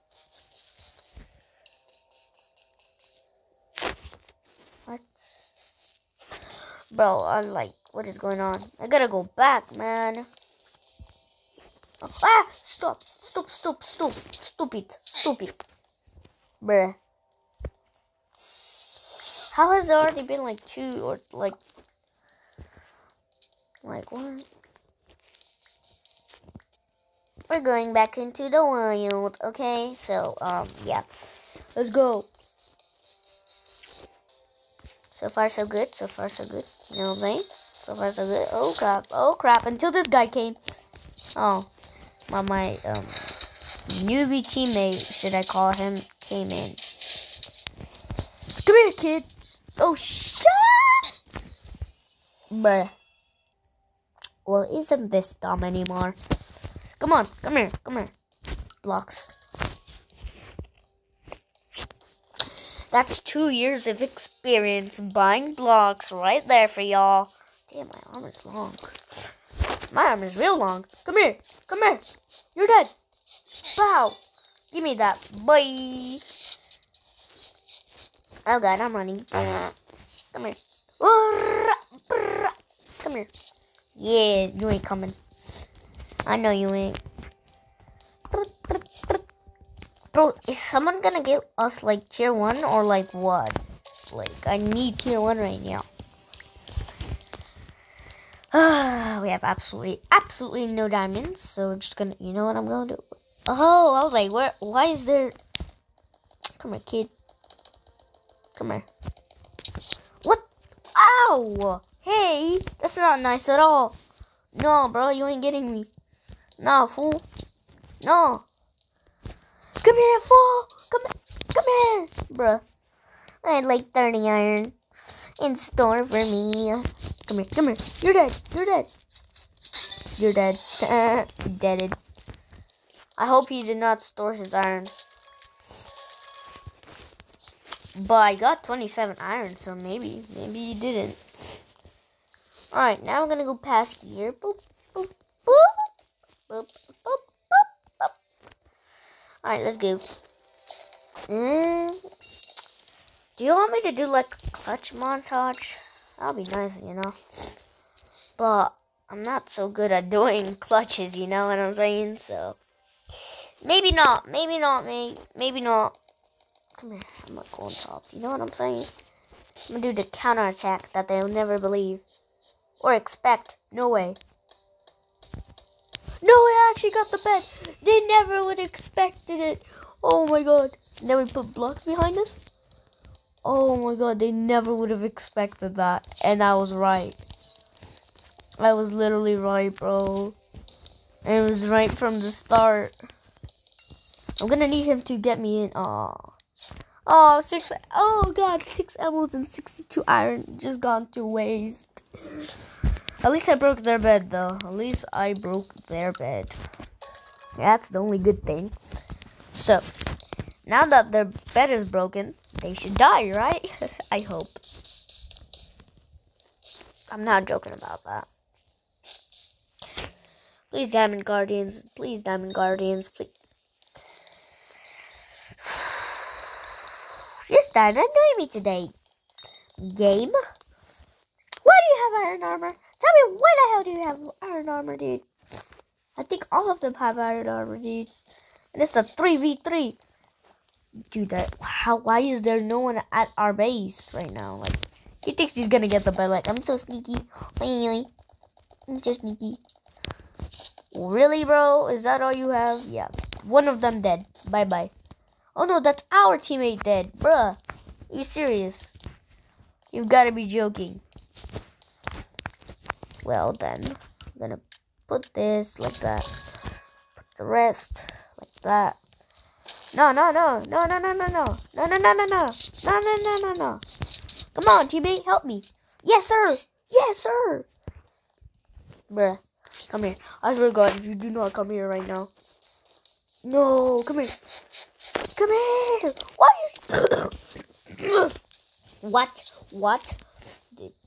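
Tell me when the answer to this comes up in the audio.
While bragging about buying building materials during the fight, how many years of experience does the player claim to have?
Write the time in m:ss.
1:03.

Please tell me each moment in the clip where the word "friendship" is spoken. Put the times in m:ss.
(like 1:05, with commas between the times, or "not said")
not said.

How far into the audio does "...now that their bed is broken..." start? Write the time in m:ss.
3:30.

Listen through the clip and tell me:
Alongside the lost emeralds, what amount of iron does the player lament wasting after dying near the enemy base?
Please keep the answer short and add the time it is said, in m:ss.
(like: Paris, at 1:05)
62, at 3:19.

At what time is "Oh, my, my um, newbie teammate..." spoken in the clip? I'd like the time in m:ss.
0:41.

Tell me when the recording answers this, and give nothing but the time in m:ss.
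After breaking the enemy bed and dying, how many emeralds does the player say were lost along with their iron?
3:18.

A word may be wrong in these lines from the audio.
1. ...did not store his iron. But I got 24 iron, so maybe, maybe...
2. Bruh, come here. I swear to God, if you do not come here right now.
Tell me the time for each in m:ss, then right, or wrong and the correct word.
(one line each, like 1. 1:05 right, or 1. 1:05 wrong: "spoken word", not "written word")
1. 2:13 wrong: "27", not "24"
2. 4:39 right.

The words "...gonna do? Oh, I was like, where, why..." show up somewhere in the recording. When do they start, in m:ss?
1:42.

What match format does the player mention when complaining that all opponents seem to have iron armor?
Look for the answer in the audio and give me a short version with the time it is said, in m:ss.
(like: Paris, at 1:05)
3v3, at 3:59.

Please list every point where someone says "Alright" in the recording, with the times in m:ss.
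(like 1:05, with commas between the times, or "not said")
2:22, 2:29.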